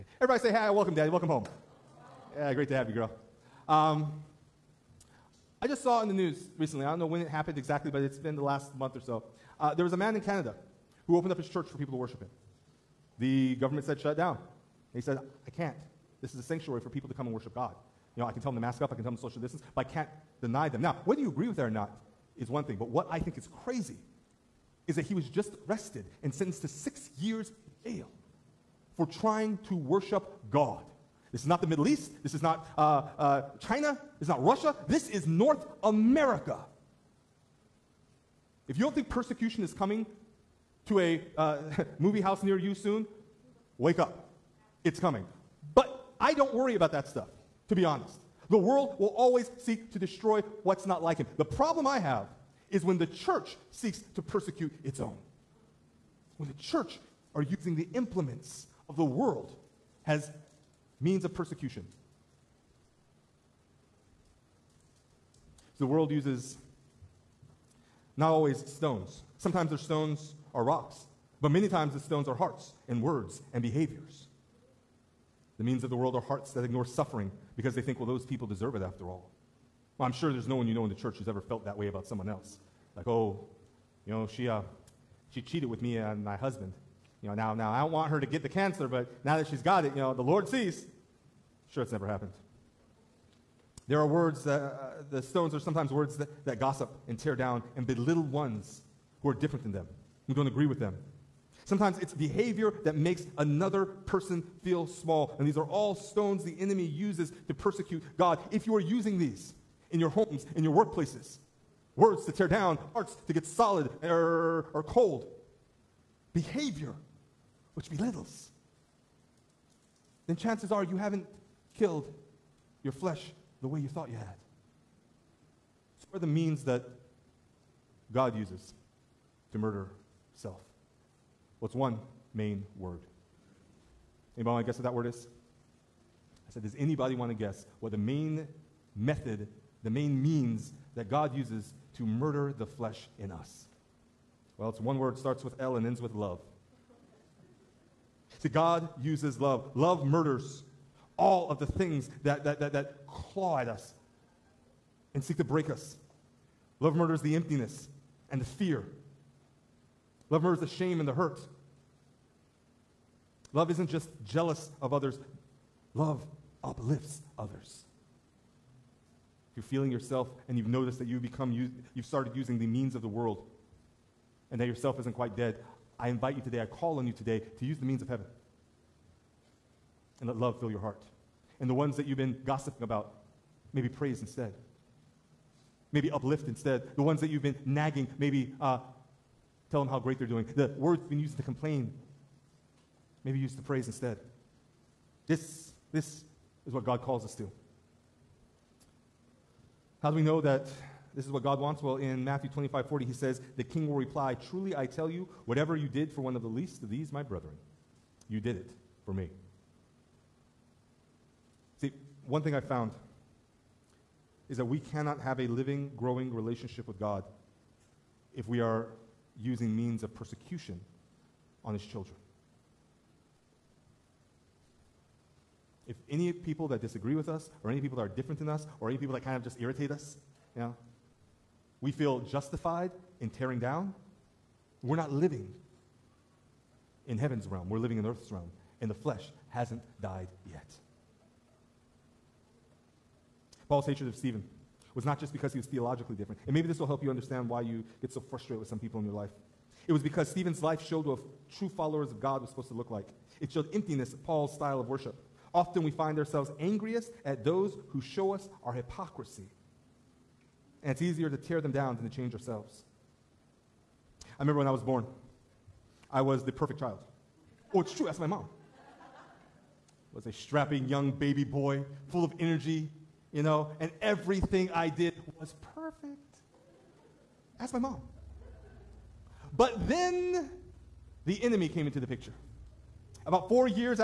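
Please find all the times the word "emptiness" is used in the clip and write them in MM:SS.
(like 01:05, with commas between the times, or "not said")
02:37, 04:13.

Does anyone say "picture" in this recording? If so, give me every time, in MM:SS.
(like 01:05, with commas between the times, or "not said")
04:42.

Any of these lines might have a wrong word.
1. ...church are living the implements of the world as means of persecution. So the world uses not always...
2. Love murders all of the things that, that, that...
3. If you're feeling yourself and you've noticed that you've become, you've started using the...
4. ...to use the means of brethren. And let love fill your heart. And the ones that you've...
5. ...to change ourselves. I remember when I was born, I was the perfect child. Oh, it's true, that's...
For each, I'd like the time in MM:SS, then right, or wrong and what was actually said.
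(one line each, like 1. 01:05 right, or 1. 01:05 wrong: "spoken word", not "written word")
1. 00:56 wrong: "using", not "living"
2. 02:29 right
3. 02:49 right
4. 02:57 wrong: "heaven", not "brethren"
5. 04:22 right.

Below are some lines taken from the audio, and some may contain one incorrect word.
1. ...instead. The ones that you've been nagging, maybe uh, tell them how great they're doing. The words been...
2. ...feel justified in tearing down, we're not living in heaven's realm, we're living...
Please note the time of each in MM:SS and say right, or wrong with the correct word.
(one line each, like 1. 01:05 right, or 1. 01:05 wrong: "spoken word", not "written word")
1. 03:06 right
2. 03:51 right.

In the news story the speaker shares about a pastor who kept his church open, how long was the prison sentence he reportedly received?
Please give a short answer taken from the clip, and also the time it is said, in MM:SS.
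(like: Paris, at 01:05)
6 years, at 00:26.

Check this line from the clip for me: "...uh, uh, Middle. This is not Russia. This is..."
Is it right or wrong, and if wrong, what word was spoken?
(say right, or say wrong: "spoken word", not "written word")
wrong: "China", not "Middle".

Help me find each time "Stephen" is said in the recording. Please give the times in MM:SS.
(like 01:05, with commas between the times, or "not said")
04:04, 04:10.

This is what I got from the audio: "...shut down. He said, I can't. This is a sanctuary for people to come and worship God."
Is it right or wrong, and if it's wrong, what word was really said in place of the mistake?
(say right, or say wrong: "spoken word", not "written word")
right.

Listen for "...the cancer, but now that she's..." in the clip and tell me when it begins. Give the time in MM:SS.
01:28.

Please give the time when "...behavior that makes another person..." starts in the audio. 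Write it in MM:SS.
01:42.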